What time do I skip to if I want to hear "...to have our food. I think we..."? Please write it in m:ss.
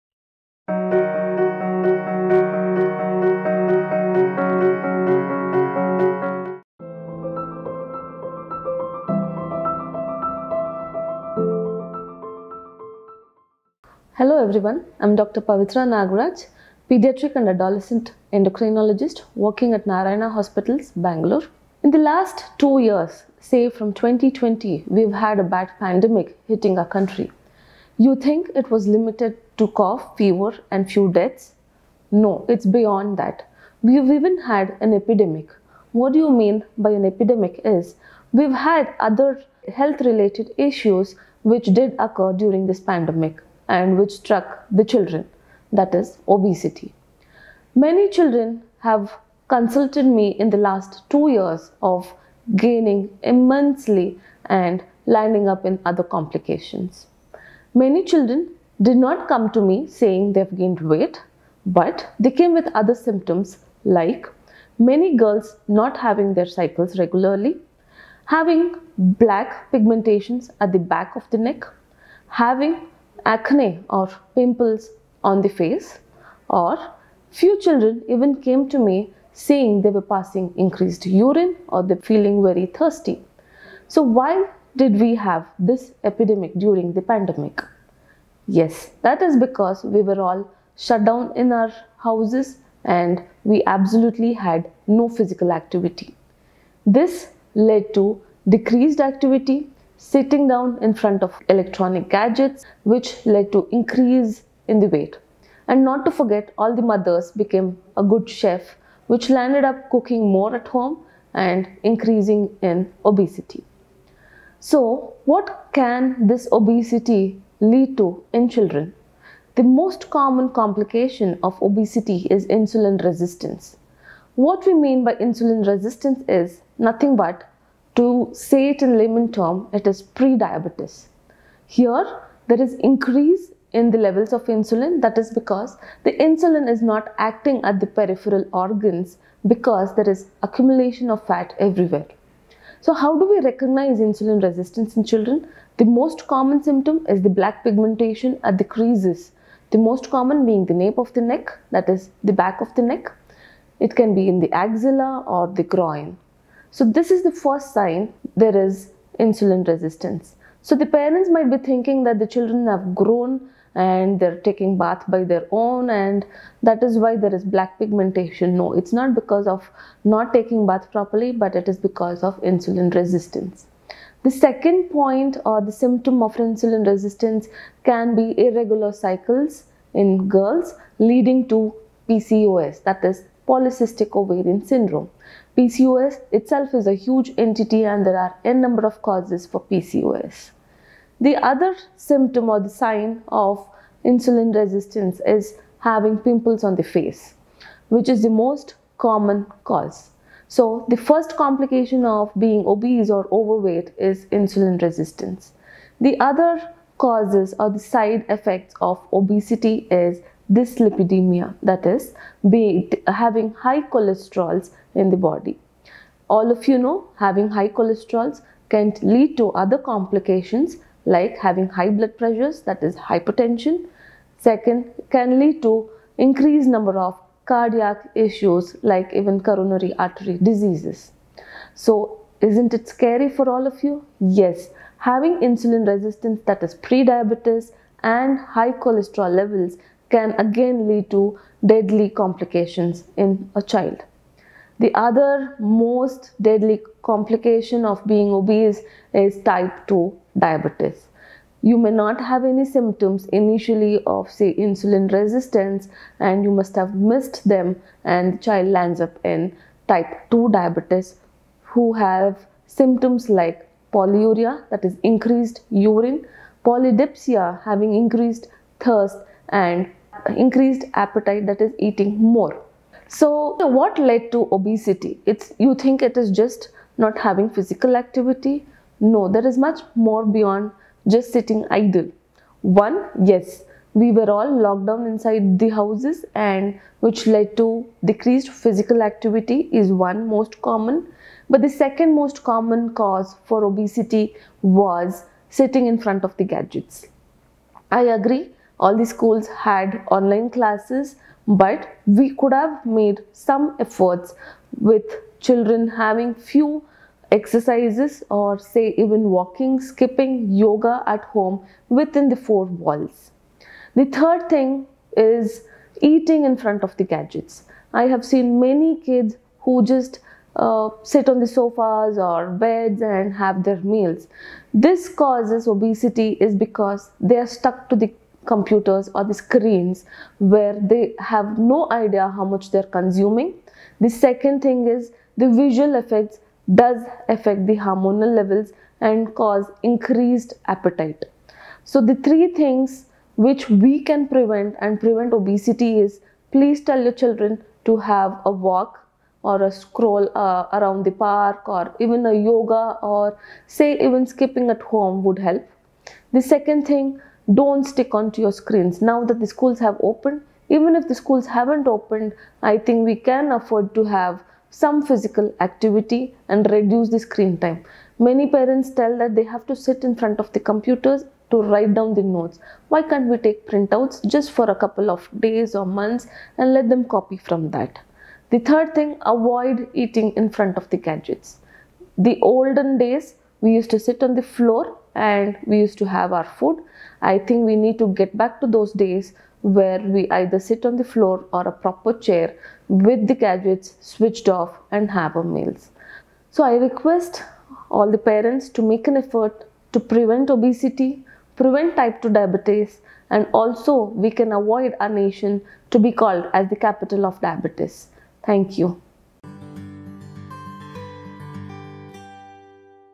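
6:25.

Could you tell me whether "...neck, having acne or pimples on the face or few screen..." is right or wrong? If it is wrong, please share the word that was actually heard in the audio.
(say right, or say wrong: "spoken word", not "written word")
wrong: "children", not "screen".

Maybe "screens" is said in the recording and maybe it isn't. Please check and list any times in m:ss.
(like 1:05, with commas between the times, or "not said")
5:29, 5:58, 6:07.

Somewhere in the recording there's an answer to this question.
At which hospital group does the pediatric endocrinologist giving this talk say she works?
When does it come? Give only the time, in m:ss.
0:19.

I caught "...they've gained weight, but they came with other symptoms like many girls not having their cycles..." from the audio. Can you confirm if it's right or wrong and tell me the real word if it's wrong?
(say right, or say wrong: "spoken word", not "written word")
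right.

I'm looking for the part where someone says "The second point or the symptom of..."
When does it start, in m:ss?
2:54.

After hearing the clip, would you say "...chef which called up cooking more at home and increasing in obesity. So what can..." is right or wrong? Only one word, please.
wrong.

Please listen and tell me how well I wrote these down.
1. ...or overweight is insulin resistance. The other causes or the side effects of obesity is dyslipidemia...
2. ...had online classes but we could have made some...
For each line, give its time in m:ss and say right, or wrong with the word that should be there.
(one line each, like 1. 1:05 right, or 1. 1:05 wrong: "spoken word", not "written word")
1. 3:23 right
2. 4:59 right.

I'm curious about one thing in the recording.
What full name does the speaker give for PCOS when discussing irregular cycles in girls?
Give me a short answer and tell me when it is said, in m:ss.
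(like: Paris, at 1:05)
Polycystic ovarian syndrome, at 3:03.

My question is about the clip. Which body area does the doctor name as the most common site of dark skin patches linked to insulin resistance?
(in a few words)
Nape of the neck.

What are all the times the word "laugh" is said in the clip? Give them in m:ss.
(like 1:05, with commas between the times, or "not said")
not said.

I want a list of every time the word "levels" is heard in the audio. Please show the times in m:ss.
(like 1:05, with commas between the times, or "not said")
2:13, 3:59, 5:38.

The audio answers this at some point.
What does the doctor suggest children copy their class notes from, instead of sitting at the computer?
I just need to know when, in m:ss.
6:13.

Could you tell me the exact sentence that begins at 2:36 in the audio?
So this is the first sign there is insulin resistance.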